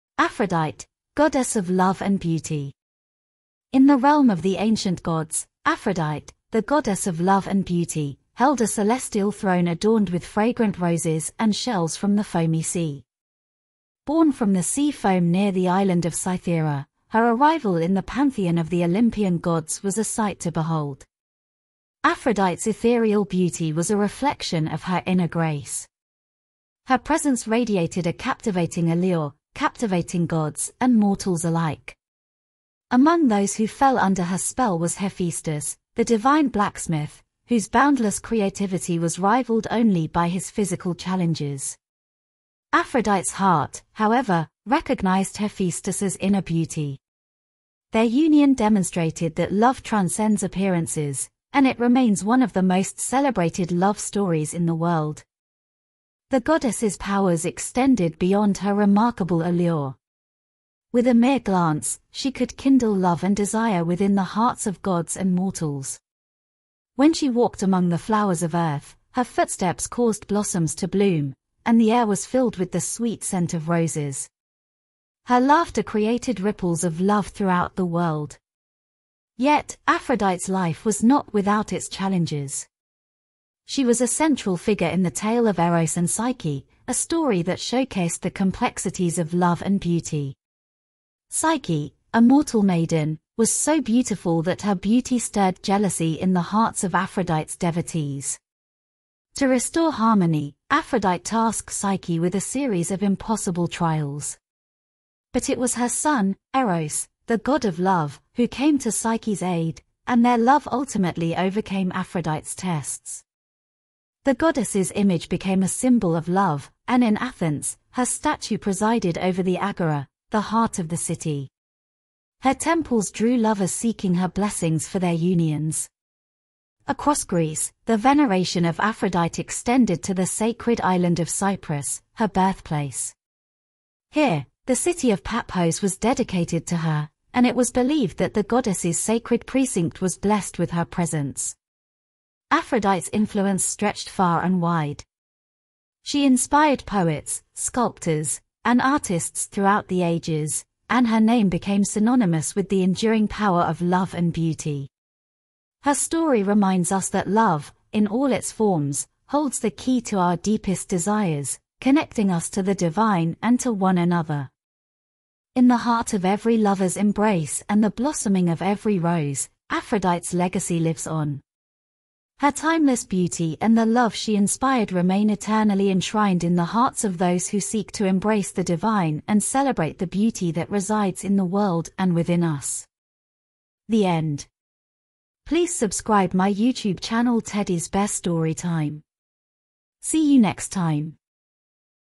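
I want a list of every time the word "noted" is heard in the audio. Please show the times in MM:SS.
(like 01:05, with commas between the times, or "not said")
not said.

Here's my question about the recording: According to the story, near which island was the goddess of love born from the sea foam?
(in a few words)
Cythera.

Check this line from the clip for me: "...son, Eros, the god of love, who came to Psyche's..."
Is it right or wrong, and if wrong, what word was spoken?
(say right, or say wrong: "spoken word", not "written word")
right.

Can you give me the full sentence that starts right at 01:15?
Her laughter created ripples of love throughout the world.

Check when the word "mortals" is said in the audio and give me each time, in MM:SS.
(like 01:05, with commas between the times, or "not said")
00:30, 01:05, 01:32.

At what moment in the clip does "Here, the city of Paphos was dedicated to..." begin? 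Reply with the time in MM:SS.
02:14.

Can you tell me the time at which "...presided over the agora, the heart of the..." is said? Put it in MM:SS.
01:58.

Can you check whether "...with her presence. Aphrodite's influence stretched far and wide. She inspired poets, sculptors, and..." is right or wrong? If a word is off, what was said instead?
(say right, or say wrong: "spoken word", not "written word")
right.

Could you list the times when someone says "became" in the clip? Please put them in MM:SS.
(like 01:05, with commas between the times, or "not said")
01:55, 02:31.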